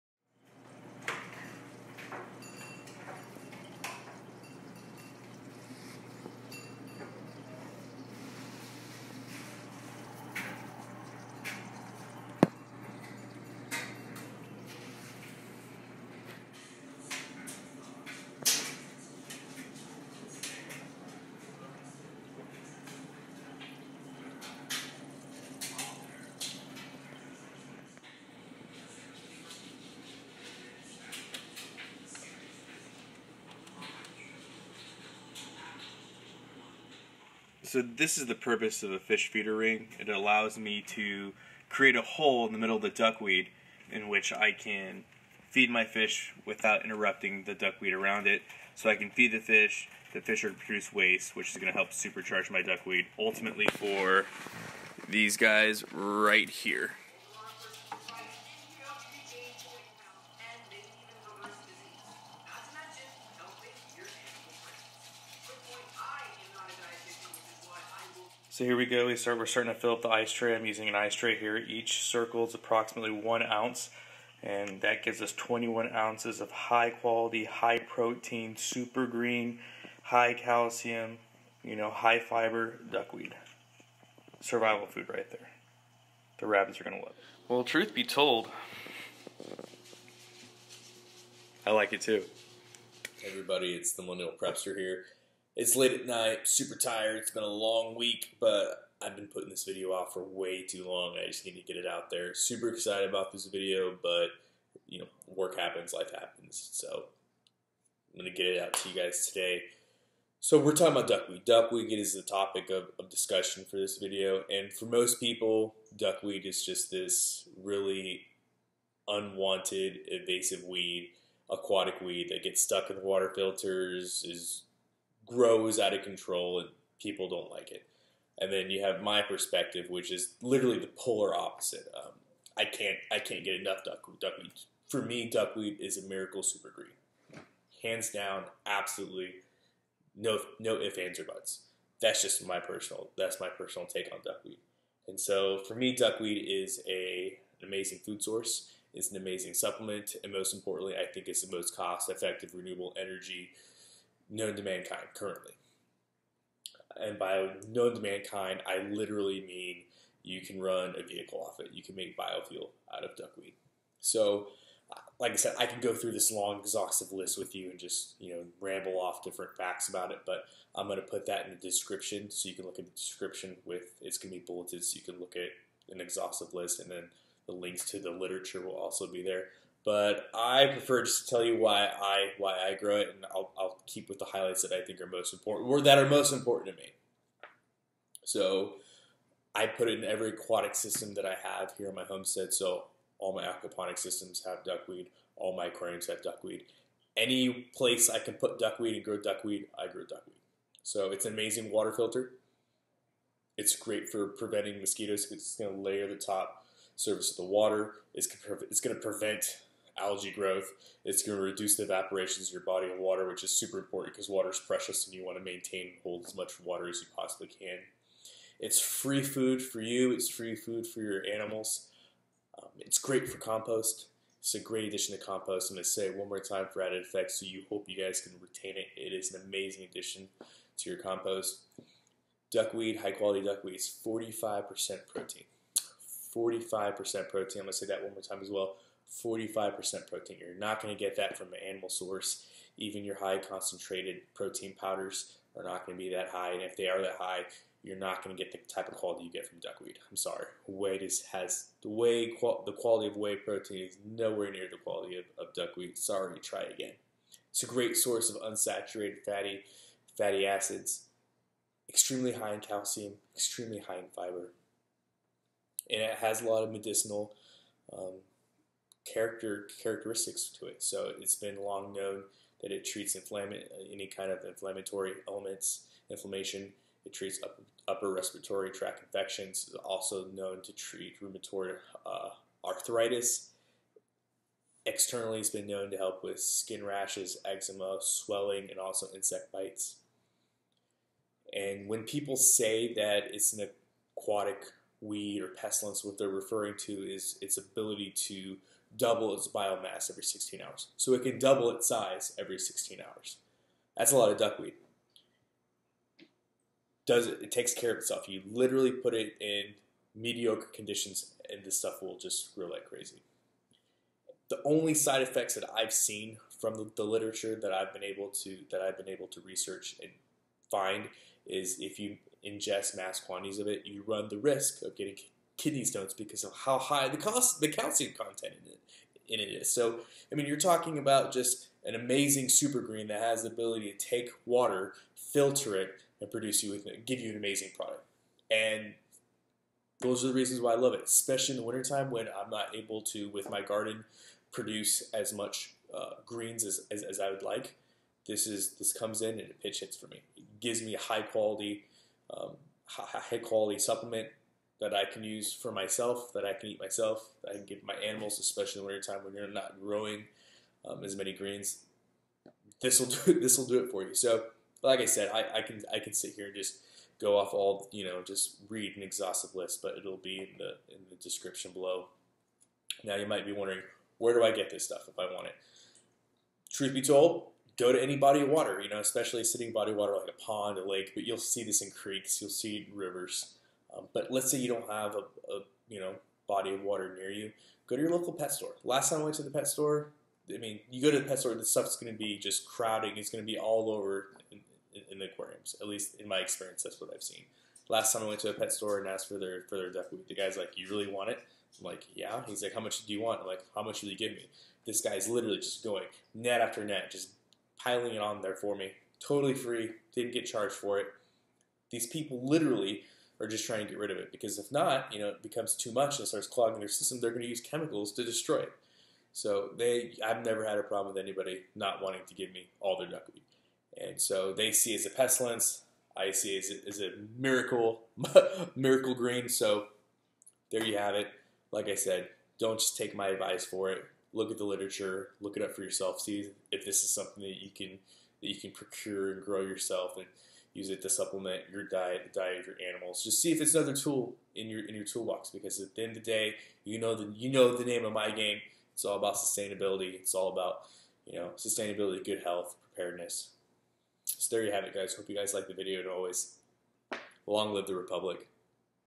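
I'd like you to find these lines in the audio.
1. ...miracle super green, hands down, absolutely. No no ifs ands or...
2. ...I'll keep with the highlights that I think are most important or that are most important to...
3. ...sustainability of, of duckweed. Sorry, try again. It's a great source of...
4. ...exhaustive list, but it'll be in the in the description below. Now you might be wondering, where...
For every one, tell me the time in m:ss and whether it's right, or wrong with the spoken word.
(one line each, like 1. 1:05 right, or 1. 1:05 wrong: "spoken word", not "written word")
1. 2:16 right
2. 3:03 right
3. 4:14 wrong: "quality", not "sustainability"
4. 6:09 right.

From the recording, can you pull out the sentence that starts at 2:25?
And so for me, duckweed is a an amazing food source.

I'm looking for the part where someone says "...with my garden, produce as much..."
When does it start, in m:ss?
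5:43.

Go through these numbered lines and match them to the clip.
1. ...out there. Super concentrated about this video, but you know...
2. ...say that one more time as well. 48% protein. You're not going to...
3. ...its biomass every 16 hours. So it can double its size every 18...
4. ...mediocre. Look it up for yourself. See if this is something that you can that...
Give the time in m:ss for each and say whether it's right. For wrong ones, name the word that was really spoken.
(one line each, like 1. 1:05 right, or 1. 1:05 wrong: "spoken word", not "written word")
1. 1:41 wrong: "excited", not "concentrated"
2. 3:57 wrong: "45", not "48"
3. 4:59 wrong: "16", not "18"
4. 7:14 wrong: "literature", not "mediocre".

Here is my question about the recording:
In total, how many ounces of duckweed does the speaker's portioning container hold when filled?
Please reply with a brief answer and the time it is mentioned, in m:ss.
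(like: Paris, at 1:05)
21 ounces, at 1:15.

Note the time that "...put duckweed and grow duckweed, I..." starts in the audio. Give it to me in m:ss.
3:18.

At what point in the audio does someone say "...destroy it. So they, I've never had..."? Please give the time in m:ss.
6:58.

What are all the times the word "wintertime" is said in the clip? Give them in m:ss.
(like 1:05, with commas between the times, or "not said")
5:41, 5:58.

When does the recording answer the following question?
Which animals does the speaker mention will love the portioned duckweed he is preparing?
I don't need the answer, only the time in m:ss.
1:26.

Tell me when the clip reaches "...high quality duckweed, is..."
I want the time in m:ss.
3:52.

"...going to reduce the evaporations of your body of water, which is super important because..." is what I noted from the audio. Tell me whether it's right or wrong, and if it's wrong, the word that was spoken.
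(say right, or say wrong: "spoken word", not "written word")
right.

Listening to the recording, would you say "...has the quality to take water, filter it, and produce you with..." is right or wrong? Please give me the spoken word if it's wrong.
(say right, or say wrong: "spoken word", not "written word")
wrong: "ability", not "quality".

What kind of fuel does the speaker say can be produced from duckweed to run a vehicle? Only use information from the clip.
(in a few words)
Biofuel.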